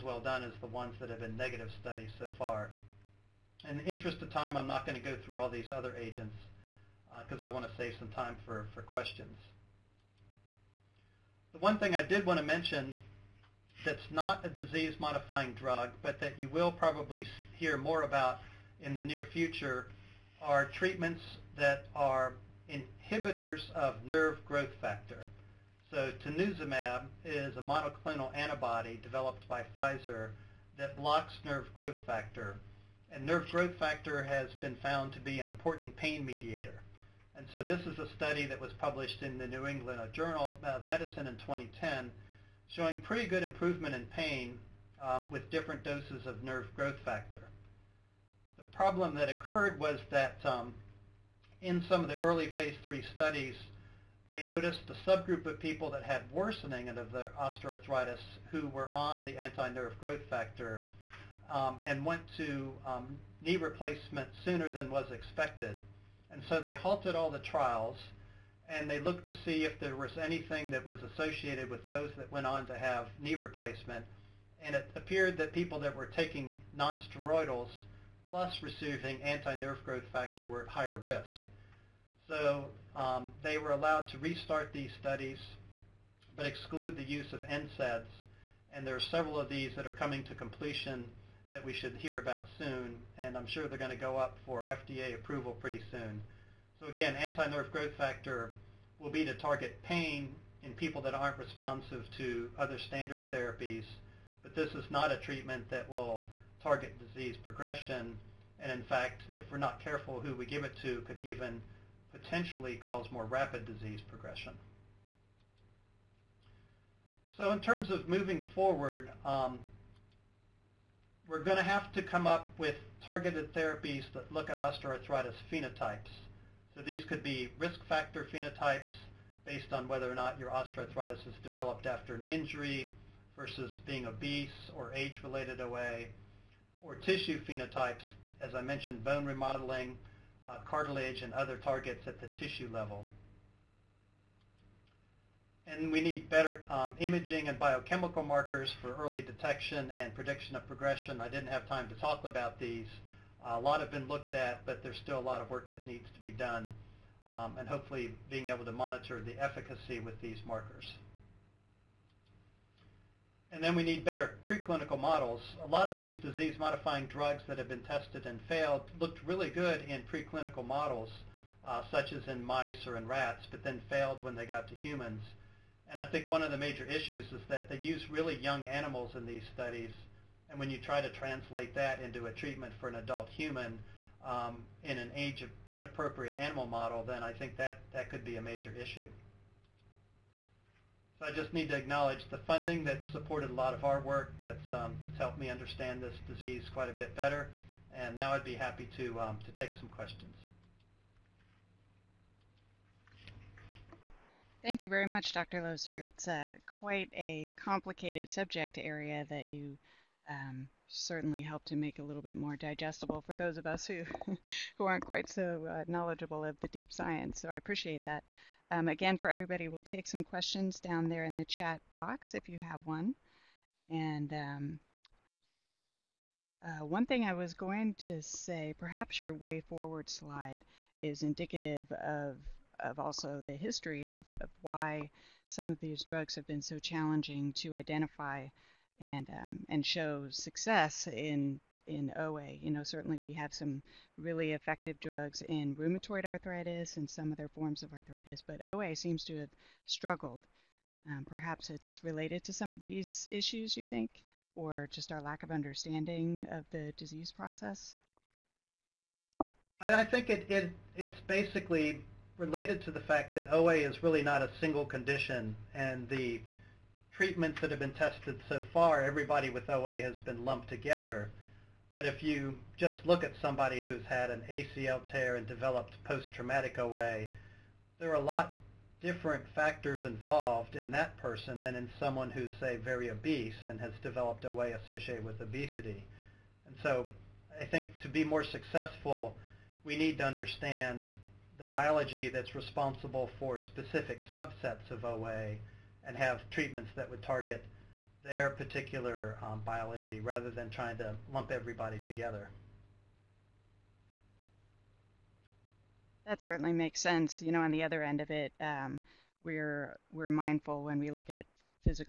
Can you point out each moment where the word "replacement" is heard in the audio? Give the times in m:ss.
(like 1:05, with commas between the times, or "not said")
1:03, 1:13.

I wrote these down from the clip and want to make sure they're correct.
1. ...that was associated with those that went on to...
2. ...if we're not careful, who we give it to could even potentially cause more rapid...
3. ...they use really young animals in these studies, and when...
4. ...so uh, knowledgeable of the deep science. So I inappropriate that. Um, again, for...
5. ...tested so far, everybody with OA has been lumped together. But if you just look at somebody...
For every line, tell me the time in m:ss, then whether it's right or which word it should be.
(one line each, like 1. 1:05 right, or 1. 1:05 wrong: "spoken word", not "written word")
1. 1:10 right
2. 1:49 right
3. 2:57 right
4. 3:35 wrong: "appreciate", not "inappropriate"
5. 4:27 right.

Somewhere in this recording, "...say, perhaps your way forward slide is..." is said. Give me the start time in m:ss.
3:48.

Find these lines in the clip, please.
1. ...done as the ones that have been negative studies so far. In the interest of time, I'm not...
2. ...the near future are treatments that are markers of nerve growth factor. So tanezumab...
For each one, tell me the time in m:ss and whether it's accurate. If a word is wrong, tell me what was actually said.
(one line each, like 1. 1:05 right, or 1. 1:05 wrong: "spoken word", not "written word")
1. 0:00 right
2. 0:18 wrong: "inhibitors", not "markers".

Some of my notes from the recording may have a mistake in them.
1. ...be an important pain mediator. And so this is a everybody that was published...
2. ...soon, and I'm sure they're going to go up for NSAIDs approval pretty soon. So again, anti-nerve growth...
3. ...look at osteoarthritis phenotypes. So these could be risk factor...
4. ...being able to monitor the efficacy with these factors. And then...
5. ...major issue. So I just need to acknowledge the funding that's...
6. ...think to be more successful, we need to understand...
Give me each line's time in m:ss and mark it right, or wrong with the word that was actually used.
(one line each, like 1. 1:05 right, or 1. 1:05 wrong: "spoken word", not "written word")
1. 0:35 wrong: "study", not "everybody"
2. 1:32 wrong: "FDA", not "NSAIDs"
3. 2:04 right
4. 2:38 wrong: "markers", not "factors"
5. 3:08 right
6. 4:47 right.